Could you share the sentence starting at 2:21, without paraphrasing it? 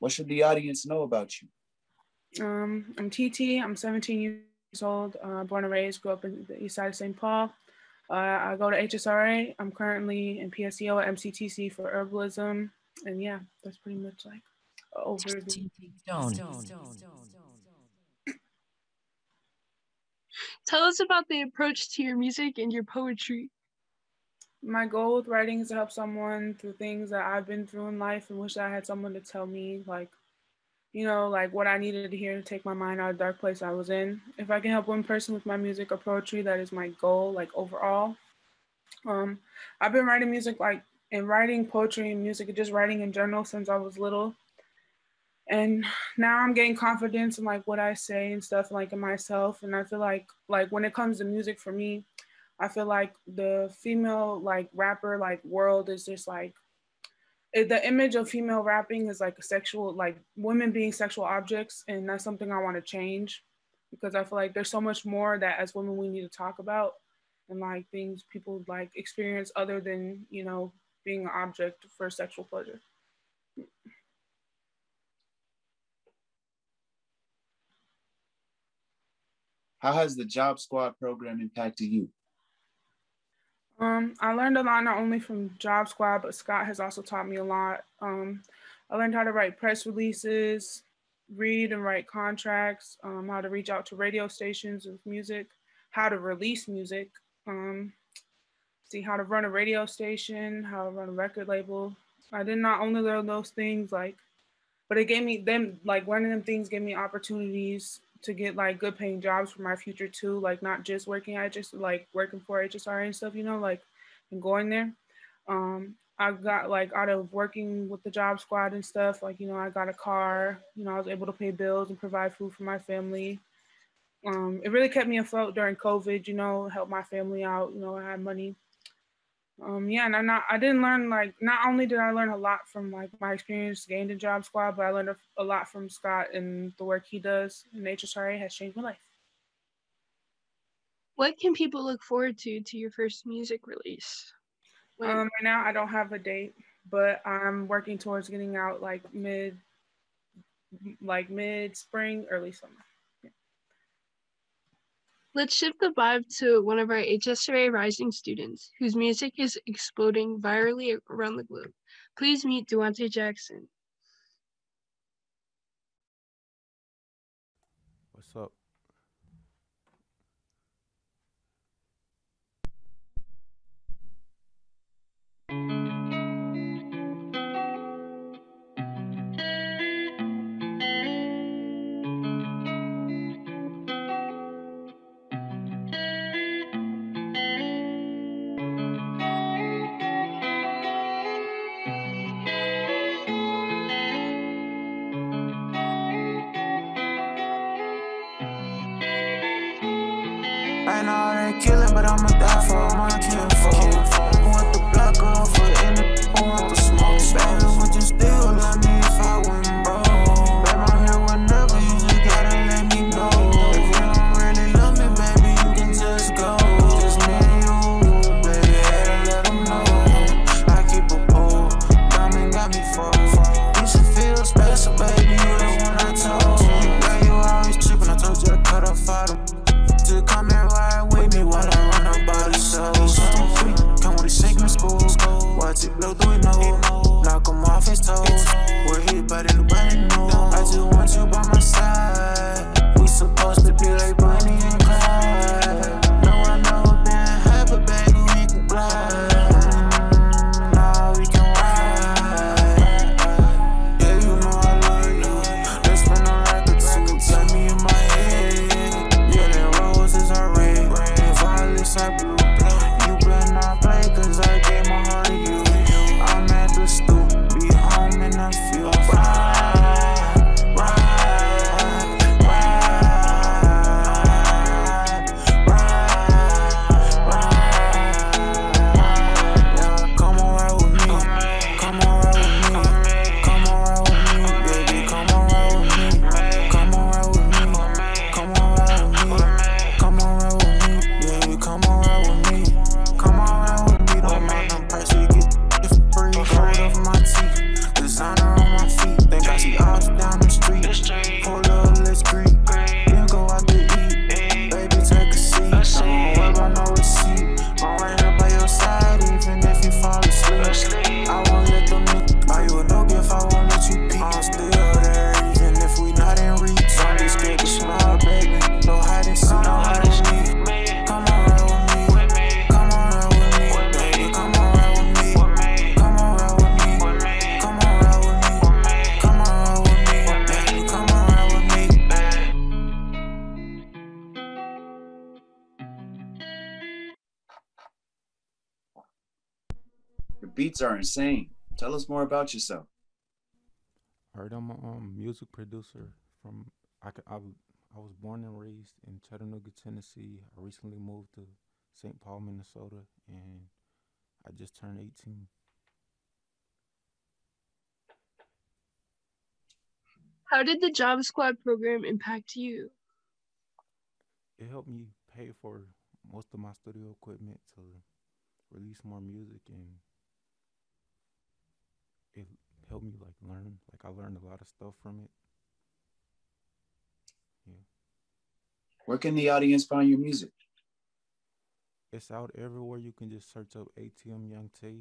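What can people look forward to to your first music release?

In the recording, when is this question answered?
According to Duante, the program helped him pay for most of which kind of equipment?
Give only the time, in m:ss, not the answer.
6:06.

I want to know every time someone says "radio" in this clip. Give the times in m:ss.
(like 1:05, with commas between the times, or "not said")
1:33, 1:39.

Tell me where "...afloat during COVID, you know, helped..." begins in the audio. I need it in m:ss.
2:05.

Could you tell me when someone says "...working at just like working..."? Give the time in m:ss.
1:51.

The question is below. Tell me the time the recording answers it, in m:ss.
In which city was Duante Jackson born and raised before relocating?
5:49.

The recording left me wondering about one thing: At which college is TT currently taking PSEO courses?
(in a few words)
MCTC.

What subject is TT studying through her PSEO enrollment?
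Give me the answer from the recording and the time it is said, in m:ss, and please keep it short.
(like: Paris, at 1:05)
Herbalism, at 0:11.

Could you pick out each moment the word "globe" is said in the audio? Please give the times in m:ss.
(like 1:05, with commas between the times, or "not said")
2:41.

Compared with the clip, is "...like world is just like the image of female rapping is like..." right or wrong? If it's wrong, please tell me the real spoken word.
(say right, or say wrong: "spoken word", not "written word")
right.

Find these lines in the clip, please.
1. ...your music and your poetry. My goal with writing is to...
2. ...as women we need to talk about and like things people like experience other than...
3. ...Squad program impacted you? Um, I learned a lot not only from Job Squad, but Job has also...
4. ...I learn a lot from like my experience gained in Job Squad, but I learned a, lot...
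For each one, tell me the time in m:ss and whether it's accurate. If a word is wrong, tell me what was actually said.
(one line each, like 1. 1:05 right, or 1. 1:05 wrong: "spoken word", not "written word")
1. 0:22 right
2. 1:05 right
3. 1:20 wrong: "Scott", not "Job"
4. 2:11 right.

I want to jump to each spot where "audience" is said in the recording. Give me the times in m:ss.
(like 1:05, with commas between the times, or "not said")
0:00, 6:19.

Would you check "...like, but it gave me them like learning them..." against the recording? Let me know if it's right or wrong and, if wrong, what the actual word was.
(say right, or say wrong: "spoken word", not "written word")
right.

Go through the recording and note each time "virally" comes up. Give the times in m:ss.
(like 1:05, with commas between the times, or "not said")
2:40.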